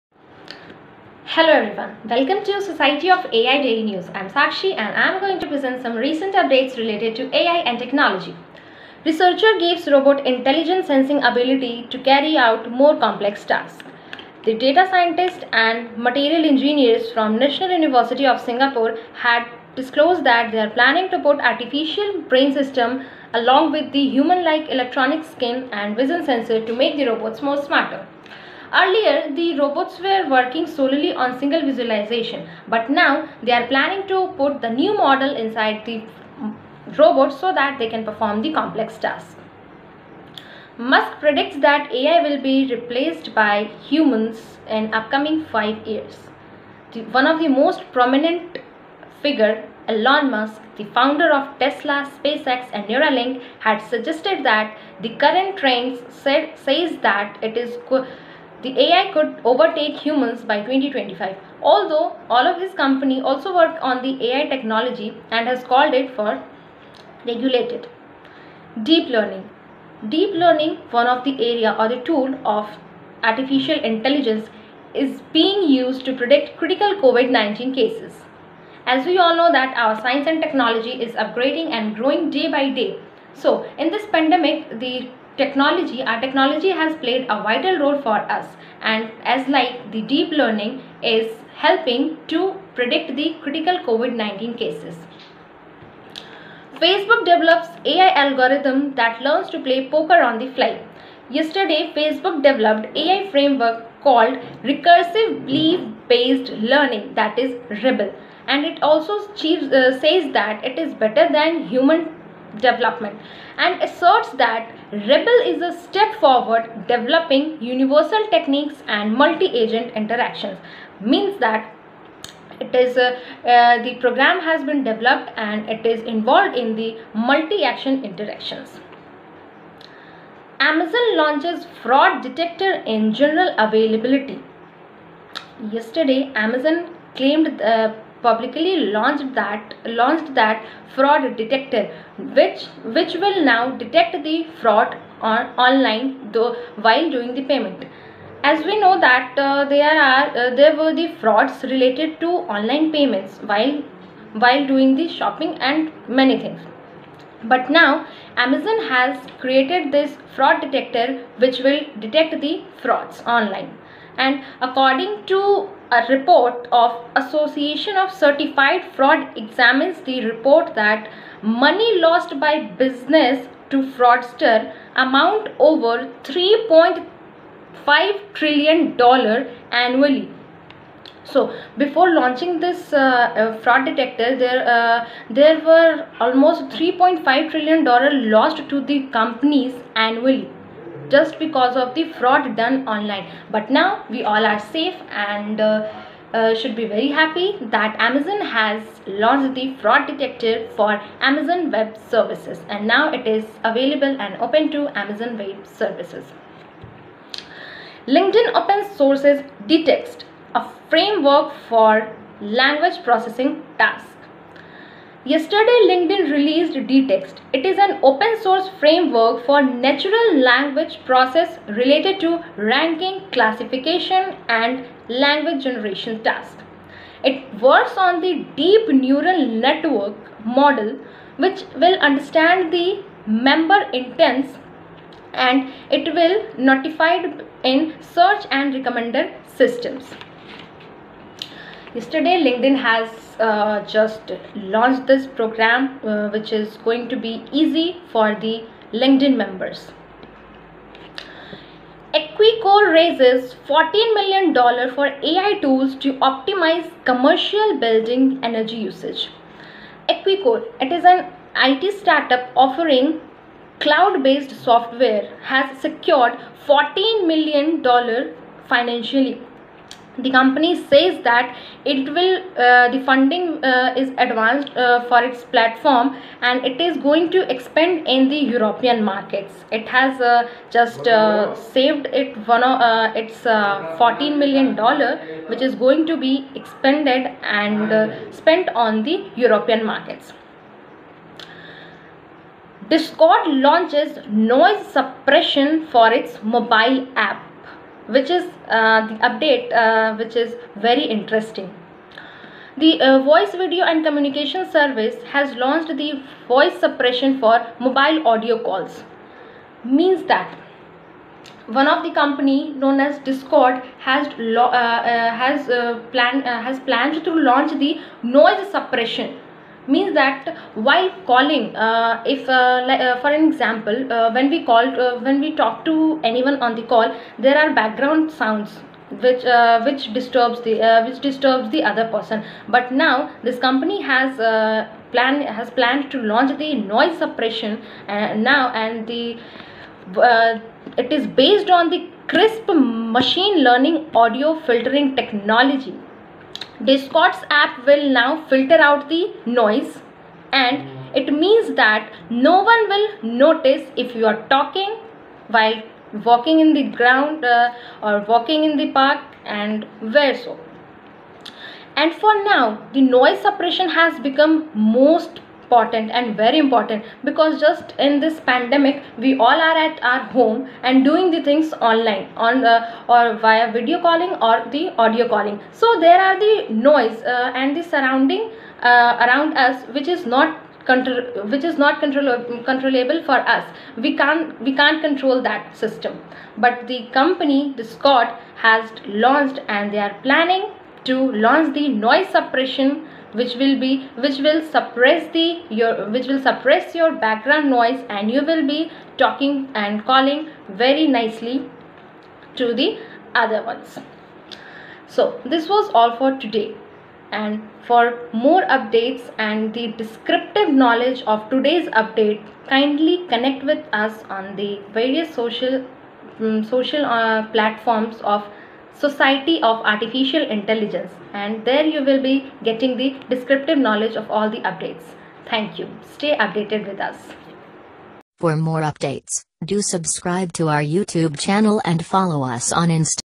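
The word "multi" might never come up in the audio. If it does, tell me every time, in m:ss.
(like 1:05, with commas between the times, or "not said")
1:59, 2:07.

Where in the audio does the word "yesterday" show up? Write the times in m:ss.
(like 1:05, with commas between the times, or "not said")
1:41, 2:15, 3:35, 4:01.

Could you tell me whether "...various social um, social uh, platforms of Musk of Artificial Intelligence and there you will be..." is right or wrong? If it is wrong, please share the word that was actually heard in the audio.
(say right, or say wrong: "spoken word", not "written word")
wrong: "Society", not "Musk".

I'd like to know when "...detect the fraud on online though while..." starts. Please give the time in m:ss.
2:23.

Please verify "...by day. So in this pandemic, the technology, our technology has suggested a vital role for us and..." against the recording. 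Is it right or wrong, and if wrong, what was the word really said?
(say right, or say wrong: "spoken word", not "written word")
wrong: "played", not "suggested".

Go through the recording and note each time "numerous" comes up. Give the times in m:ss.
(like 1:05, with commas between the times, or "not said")
not said.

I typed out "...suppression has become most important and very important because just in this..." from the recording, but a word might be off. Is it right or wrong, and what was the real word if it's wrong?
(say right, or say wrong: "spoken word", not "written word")
right.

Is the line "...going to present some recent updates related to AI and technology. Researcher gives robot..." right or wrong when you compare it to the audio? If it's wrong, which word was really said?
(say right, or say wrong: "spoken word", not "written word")
right.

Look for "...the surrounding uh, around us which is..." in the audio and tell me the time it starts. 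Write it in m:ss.
6:17.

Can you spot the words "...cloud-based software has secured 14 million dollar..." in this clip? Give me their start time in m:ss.
4:23.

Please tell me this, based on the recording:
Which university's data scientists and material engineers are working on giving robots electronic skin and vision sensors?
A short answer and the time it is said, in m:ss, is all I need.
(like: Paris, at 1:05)
National University of Singapore, at 0:17.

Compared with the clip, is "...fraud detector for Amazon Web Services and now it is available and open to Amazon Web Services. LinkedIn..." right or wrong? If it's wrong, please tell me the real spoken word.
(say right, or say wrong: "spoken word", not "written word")
right.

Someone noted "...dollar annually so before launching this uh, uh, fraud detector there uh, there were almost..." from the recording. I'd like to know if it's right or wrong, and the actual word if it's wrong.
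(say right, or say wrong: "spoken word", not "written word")
right.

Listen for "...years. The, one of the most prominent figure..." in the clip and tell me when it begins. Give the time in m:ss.
0:45.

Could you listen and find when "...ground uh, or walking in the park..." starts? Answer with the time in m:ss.
5:56.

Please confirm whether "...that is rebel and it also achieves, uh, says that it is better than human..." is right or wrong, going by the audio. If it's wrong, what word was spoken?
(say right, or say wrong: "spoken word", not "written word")
right.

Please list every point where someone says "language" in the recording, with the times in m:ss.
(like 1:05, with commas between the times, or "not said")
3:32, 3:40, 3:45.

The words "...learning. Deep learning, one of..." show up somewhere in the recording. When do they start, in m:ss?
1:09.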